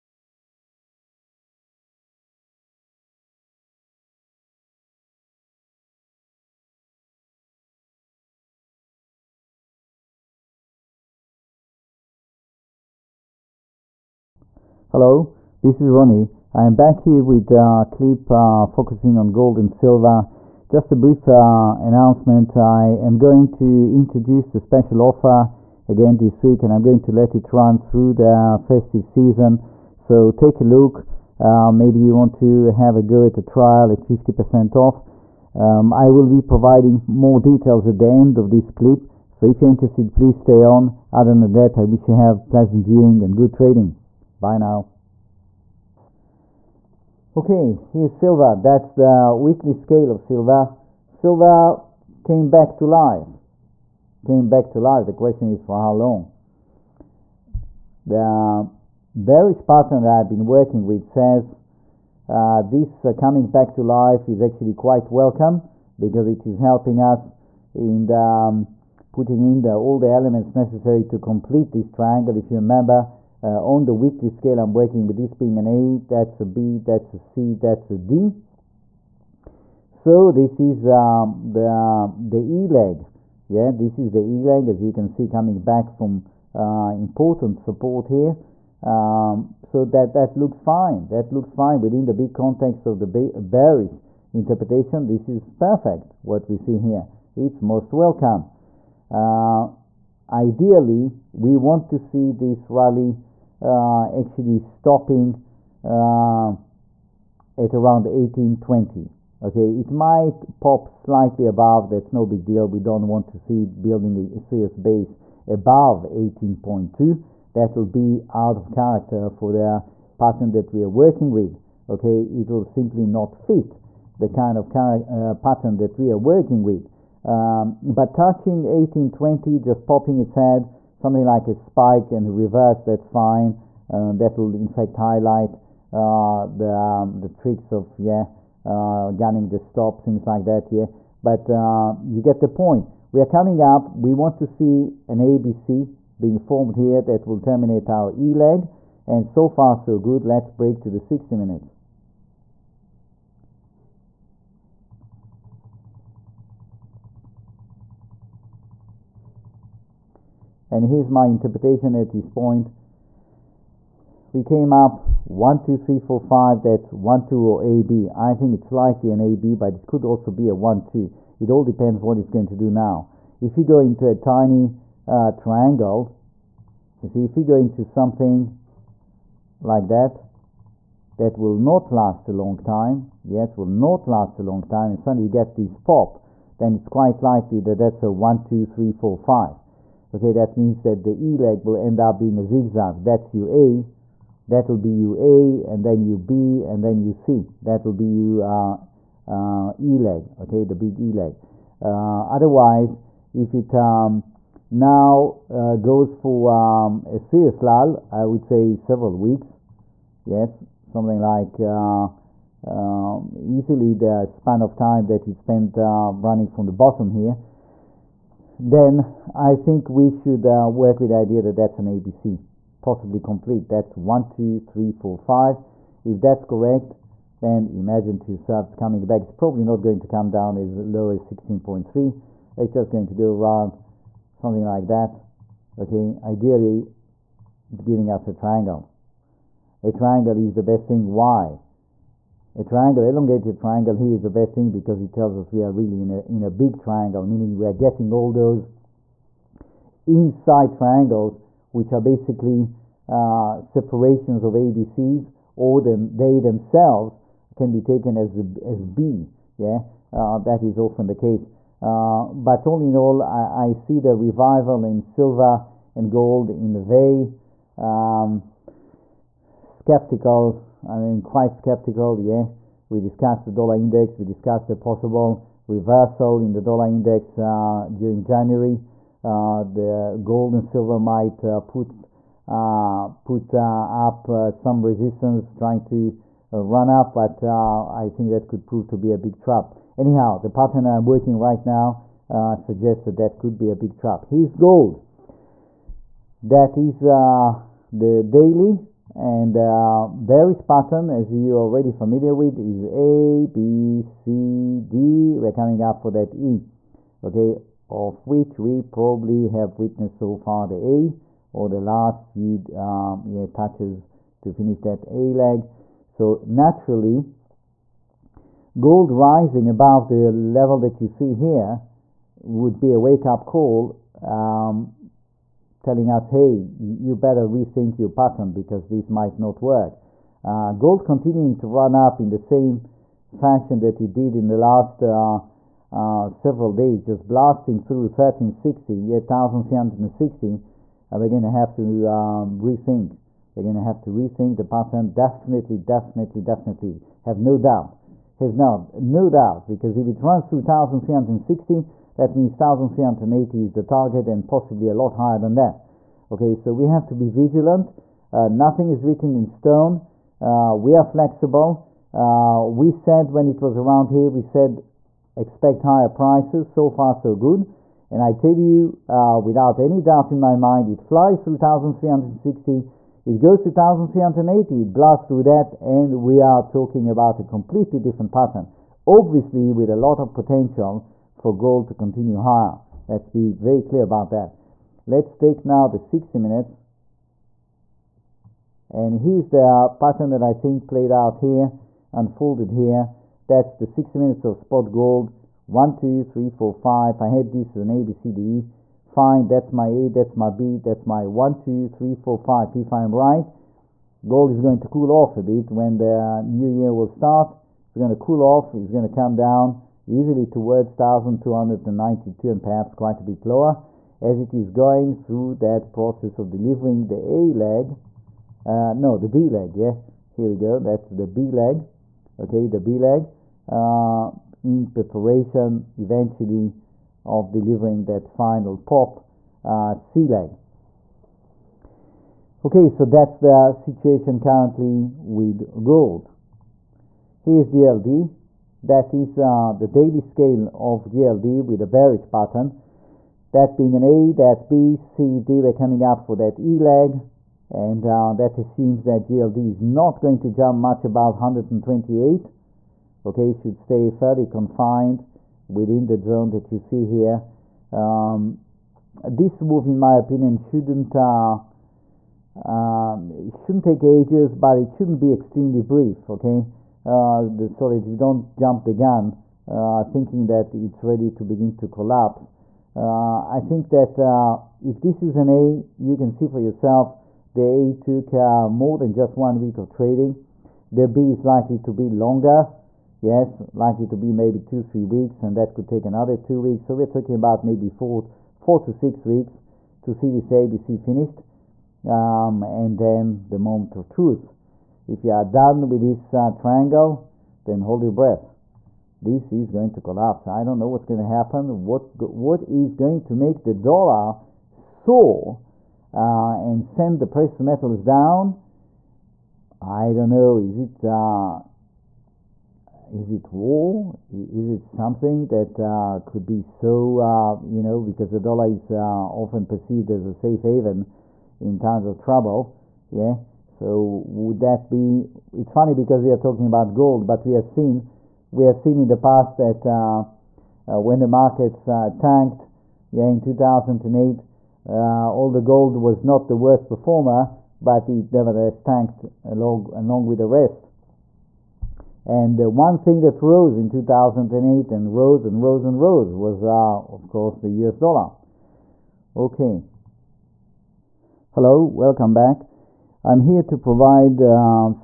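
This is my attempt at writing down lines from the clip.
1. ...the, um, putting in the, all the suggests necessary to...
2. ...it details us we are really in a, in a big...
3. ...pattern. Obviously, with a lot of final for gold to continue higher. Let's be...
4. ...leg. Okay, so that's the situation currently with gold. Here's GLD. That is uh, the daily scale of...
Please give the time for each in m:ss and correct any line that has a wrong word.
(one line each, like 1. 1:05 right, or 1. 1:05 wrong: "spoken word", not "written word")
1. 1:08 wrong: "elements", not "suggests"
2. 4:04 wrong: "tells", not "details"
3. 6:18 wrong: "potential", not "final"
4. 7:10 right.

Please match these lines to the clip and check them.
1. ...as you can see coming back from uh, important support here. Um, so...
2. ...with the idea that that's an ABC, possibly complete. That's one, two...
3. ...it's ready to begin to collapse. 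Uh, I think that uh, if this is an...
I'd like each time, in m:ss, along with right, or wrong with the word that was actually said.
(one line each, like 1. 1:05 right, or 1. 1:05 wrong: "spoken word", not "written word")
1. 1:24 right
2. 3:40 right
3. 7:50 right.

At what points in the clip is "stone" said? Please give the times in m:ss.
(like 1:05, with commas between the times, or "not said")
5:59.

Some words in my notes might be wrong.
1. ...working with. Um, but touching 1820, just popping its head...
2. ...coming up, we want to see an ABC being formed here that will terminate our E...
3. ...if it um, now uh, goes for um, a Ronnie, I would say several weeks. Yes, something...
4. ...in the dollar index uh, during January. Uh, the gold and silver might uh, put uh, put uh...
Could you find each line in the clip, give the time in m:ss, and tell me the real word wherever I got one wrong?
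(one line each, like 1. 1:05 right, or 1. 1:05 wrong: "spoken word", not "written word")
1. 2:06 right
2. 2:23 right
3. 3:23 wrong: "CSLAL", not "Ronnie"
4. 4:36 right.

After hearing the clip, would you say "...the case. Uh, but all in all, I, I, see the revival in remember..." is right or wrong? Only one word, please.
wrong.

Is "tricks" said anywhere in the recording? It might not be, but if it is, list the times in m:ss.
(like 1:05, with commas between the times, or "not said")
2:17.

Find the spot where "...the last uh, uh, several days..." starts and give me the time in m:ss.
5:34.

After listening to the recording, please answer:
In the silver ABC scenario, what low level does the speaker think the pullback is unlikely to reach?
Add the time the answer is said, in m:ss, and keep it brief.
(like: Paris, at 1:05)
16.3, at 3:51.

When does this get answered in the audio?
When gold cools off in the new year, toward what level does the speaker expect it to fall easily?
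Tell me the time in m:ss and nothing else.
6:50.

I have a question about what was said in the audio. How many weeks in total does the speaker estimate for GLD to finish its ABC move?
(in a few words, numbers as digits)
4 to 6 weeks.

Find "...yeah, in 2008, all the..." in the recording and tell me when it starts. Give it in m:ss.
8:53.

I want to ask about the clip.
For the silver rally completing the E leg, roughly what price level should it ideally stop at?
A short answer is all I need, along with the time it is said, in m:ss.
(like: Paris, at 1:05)
1820, at 1:47.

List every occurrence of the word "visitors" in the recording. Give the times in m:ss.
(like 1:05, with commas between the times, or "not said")
not said.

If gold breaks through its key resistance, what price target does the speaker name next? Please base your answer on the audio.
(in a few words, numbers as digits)
1380.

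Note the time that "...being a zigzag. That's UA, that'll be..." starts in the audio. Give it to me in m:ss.
3:12.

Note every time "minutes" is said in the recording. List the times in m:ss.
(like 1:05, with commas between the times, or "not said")
2:31, 6:26, 6:34.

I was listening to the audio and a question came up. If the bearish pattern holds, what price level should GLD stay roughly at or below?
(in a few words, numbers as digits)
128.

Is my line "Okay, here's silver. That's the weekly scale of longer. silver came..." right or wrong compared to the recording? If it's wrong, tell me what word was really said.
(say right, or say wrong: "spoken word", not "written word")
wrong: "silver", not "longer".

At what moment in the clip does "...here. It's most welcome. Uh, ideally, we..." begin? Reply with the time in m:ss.
1:36.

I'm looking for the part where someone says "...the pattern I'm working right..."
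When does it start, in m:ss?
4:50.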